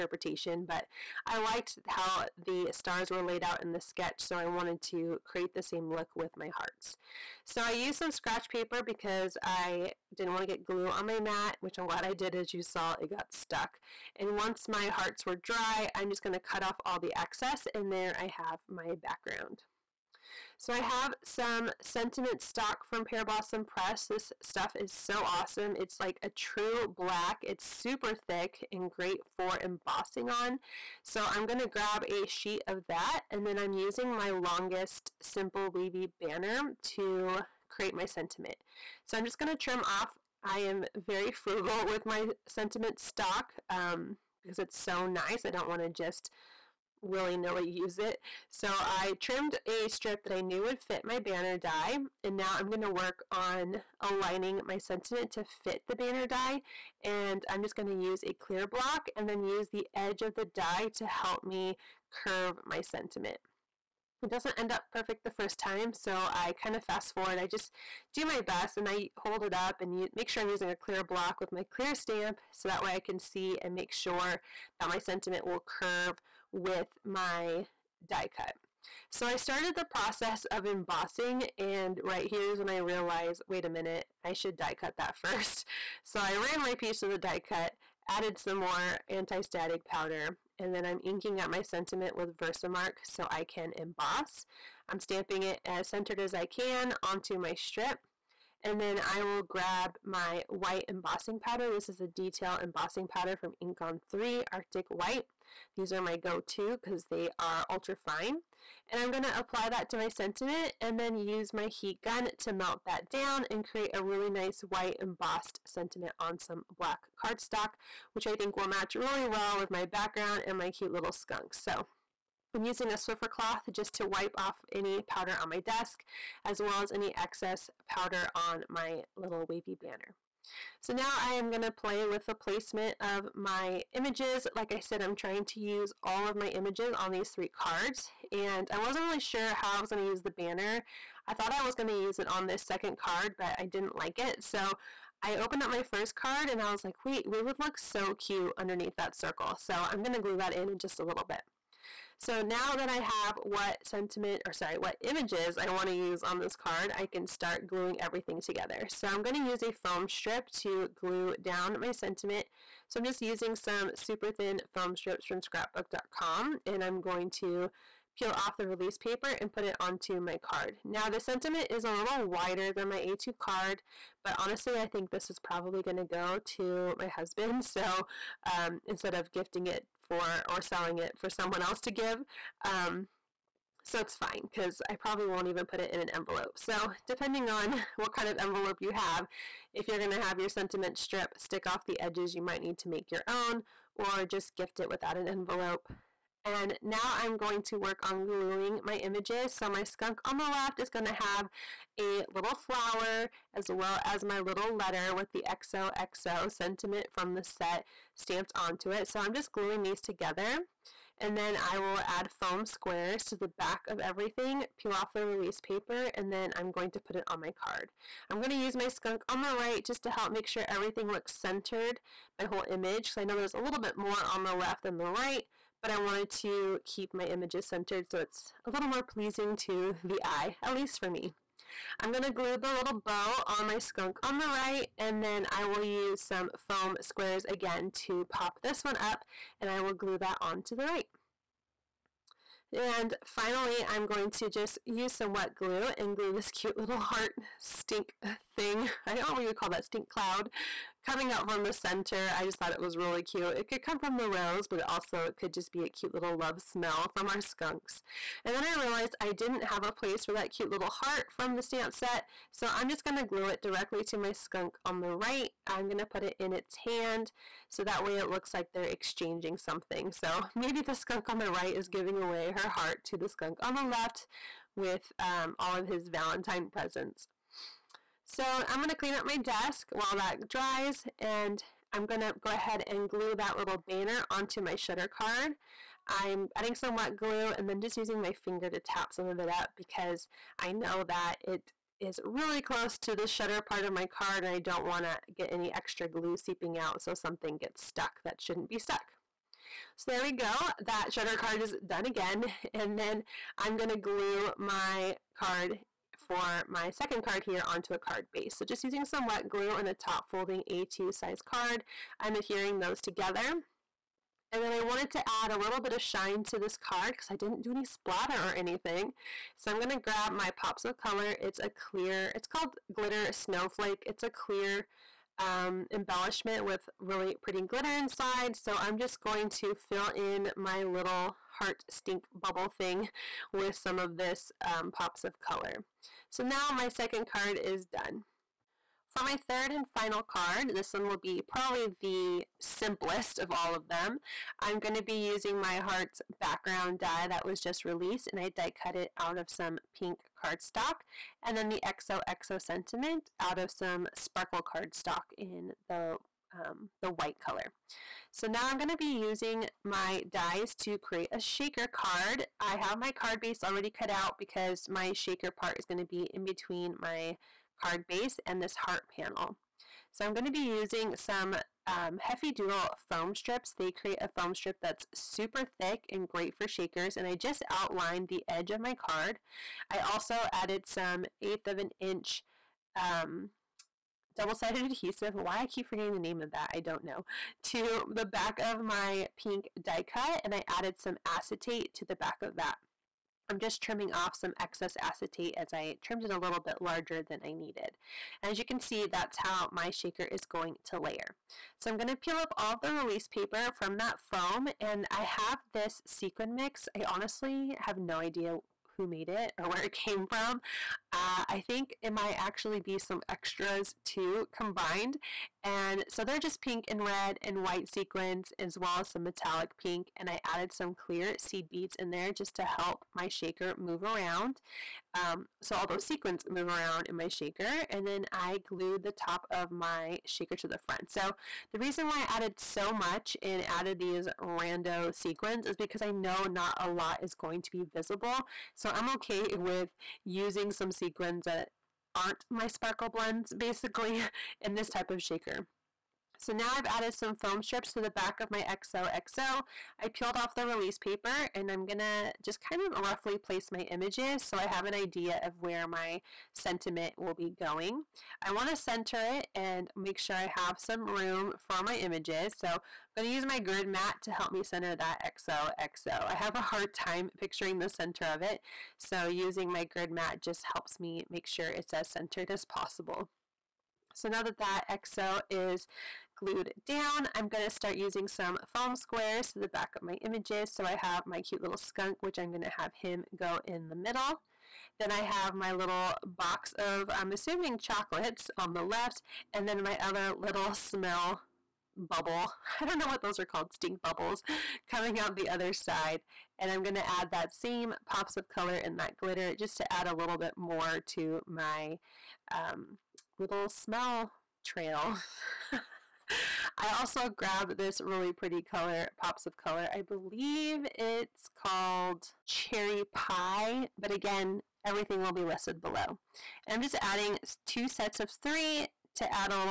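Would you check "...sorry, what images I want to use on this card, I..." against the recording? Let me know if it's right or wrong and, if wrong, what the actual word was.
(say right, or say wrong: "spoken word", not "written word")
right.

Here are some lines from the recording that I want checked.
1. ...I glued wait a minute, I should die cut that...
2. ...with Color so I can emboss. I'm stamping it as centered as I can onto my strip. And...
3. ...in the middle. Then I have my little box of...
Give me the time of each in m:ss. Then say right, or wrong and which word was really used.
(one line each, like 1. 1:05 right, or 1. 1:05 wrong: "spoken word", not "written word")
1. 1:22 wrong: "realized", not "glued"
2. 1:32 wrong: "Versamark", not "Color"
3. 8:03 right.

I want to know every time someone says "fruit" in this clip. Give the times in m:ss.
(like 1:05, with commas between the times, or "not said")
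not said.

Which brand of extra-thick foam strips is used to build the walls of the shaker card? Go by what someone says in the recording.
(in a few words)
Heffy Doodle.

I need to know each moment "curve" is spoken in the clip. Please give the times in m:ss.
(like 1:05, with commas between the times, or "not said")
1:02, 1:15.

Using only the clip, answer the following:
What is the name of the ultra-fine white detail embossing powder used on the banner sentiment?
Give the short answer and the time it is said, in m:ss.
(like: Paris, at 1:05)
Arctic White, at 1:44.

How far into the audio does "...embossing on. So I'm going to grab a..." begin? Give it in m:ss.
0:29.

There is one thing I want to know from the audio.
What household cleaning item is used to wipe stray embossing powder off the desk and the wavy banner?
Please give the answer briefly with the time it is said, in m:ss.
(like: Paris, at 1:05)
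Swiffer cloth, at 2:02.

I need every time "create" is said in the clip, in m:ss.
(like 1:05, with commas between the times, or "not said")
0:05, 0:37, 1:53, 6:00, 6:13.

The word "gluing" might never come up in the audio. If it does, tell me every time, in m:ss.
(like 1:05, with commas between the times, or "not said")
2:37, 3:18, 3:29.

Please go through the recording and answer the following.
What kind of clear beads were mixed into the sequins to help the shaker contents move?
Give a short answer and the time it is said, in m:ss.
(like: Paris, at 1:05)
seed beads, at 7:01.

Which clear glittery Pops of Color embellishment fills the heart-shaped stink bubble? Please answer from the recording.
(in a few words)
Glitter Snowflake.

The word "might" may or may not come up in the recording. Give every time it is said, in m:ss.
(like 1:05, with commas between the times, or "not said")
3:12, 6:52.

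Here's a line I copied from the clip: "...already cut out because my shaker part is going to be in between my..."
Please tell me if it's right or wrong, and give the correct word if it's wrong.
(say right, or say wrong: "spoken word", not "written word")
right.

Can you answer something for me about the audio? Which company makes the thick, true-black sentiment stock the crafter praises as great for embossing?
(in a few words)
Pear Blossom Press.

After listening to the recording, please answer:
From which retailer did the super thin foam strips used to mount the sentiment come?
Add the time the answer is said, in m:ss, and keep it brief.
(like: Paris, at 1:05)
scrapbook.com, at 2:45.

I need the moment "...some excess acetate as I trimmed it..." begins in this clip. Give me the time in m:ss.
6:34.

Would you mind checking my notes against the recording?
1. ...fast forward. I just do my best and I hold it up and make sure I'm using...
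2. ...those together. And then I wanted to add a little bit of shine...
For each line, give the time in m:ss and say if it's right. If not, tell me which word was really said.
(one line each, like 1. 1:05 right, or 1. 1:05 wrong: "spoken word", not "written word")
1. 1:06 right
2. 5:12 right.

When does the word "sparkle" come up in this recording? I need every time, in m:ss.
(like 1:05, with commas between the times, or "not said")
5:54, 7:22.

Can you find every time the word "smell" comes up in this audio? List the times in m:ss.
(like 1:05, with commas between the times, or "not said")
4:16, 8:10, 8:23.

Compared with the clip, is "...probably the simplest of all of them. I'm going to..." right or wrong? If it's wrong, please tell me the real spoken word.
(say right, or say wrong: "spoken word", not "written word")
right.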